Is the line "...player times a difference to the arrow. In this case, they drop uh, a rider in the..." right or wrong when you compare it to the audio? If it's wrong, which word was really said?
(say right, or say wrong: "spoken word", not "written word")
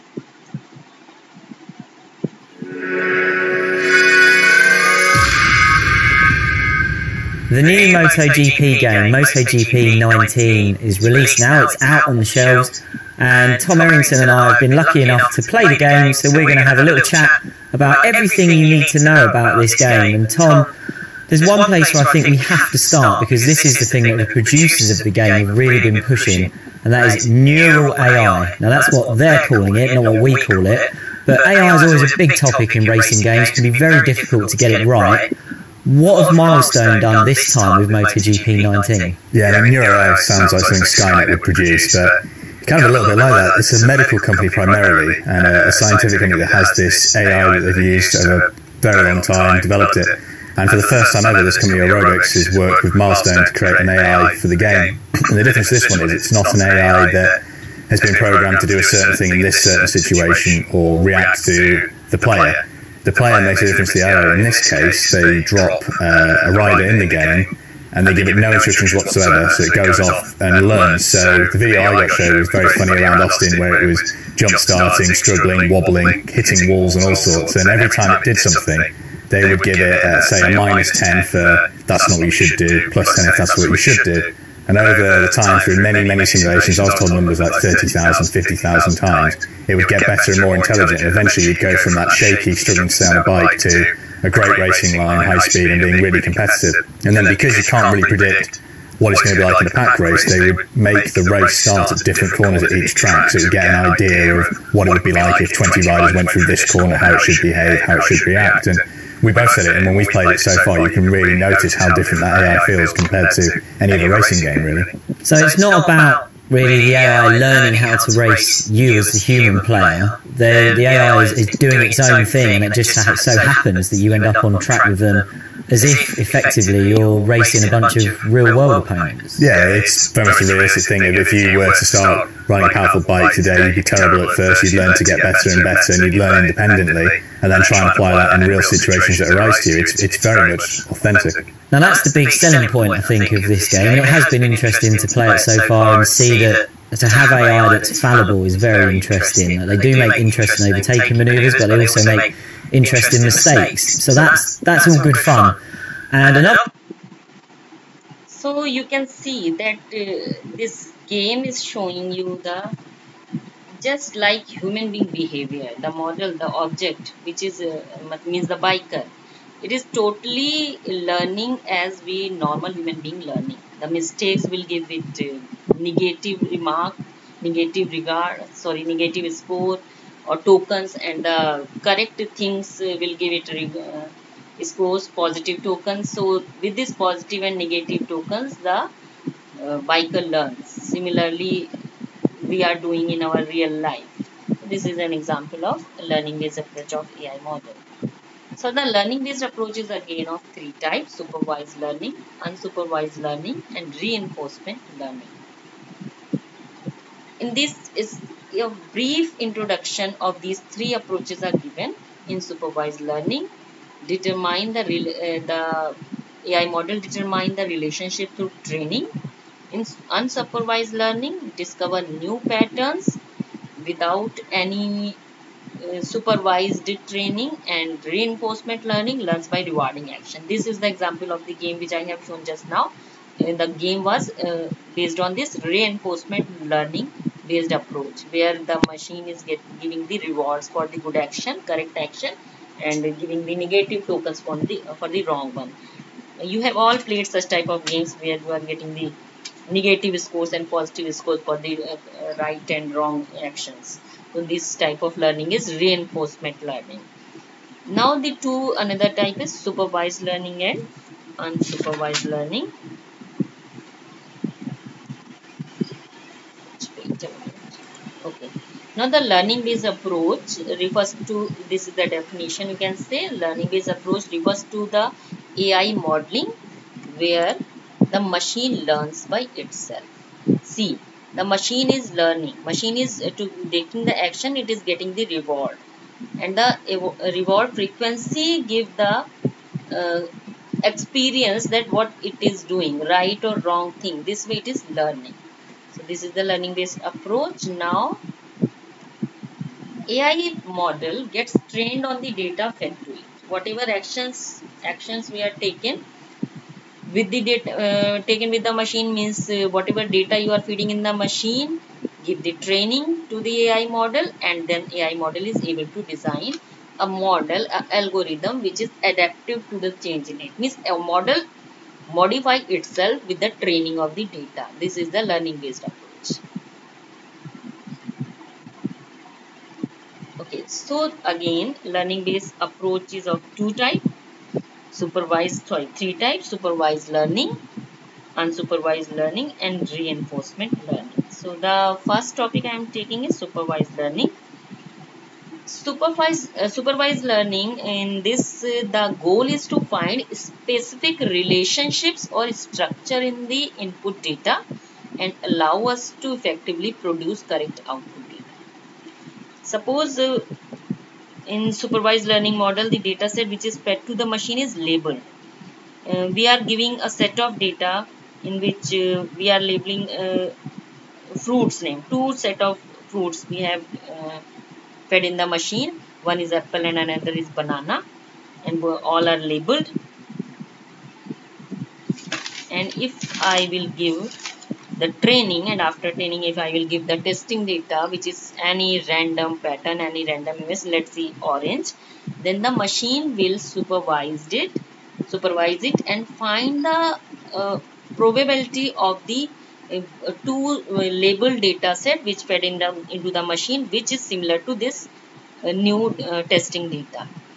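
wrong: "makes", not "times".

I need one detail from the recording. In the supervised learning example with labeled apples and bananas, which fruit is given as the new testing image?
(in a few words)
orange.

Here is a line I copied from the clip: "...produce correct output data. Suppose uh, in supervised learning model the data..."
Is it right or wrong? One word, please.
right.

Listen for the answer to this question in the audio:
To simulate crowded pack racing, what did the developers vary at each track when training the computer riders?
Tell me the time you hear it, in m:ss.
1:42.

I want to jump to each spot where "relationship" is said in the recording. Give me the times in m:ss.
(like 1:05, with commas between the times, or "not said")
3:37, 5:51.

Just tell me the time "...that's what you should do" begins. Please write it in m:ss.
1:23.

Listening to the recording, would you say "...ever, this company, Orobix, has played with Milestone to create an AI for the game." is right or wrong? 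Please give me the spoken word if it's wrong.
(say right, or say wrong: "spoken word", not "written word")
wrong: "worked", not "played".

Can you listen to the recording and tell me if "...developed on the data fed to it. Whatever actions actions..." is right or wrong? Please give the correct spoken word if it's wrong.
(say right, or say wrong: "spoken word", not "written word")
wrong: "trained", not "developed".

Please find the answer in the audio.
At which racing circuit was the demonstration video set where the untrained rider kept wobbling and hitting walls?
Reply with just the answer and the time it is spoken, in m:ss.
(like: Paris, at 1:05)
Austin, at 1:13.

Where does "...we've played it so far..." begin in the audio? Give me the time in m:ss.
1:49.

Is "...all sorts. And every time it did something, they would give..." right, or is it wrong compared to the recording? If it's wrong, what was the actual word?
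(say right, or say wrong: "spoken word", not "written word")
right.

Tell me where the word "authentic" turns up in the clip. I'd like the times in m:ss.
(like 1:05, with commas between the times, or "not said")
2:20.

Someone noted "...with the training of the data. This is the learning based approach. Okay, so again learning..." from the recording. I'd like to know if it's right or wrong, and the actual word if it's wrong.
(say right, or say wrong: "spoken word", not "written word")
right.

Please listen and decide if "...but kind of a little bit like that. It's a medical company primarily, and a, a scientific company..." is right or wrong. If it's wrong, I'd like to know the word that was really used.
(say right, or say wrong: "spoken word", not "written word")
right.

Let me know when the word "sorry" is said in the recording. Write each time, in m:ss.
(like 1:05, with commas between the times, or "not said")
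2:58, 5:35.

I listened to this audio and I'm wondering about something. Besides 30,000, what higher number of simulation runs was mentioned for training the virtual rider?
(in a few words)
50,000.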